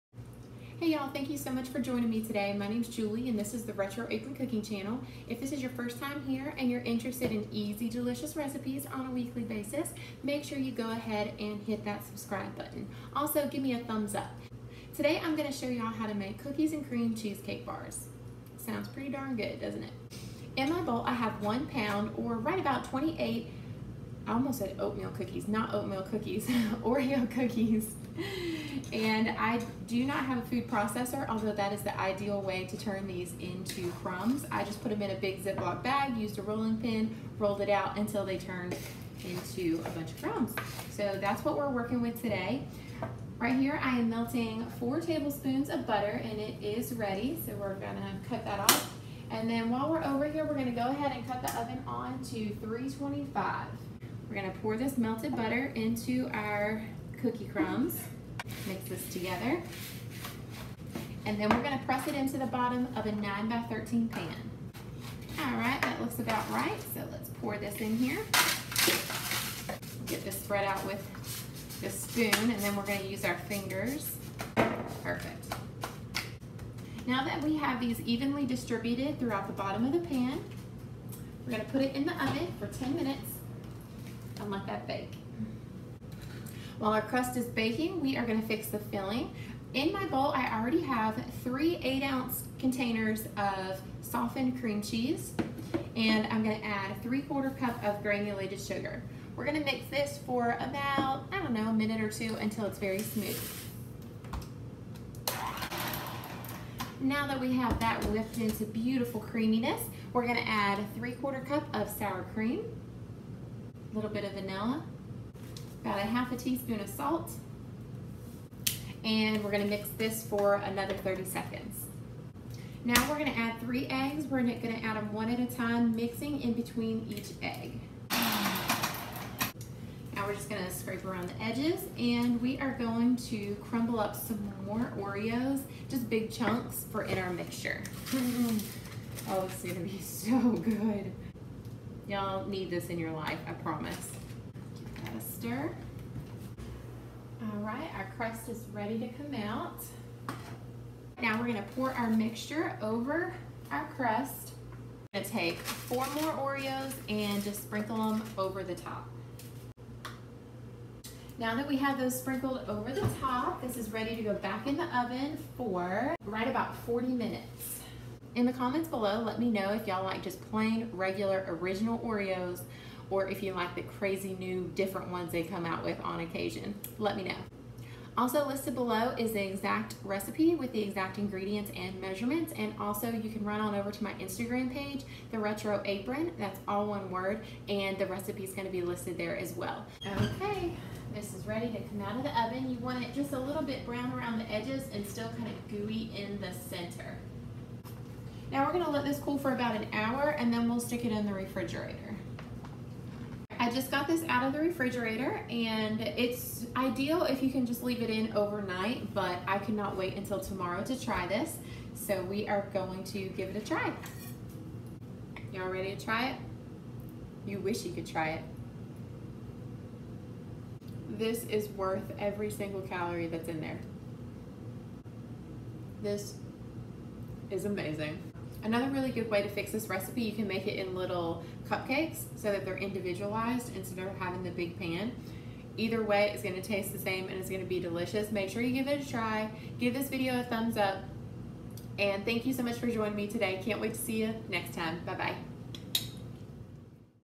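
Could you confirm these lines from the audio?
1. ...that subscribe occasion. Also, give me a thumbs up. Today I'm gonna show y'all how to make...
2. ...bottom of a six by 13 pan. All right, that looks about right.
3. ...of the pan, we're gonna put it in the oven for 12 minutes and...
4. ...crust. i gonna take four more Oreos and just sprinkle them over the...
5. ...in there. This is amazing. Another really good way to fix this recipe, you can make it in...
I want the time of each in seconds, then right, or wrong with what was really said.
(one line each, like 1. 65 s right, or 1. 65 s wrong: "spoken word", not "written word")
1. 11 s wrong: "button", not "occasion"
2. 62 s wrong: "nine", not "six"
3. 79 s wrong: "10", not "12"
4. 153 s right
5. 223 s right.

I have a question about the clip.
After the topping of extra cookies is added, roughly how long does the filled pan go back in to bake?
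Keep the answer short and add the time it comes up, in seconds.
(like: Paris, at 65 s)
40 minutes, at 166 s.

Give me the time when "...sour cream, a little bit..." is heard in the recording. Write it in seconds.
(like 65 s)
111 s.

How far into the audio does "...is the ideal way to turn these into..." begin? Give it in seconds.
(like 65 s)
31 s.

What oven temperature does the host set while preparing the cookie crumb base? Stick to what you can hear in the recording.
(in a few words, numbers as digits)
325.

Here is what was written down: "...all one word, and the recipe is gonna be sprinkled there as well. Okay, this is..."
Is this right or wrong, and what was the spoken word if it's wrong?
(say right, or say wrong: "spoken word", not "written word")
wrong: "listed", not "sprinkled".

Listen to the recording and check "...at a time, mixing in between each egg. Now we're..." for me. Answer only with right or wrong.
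right.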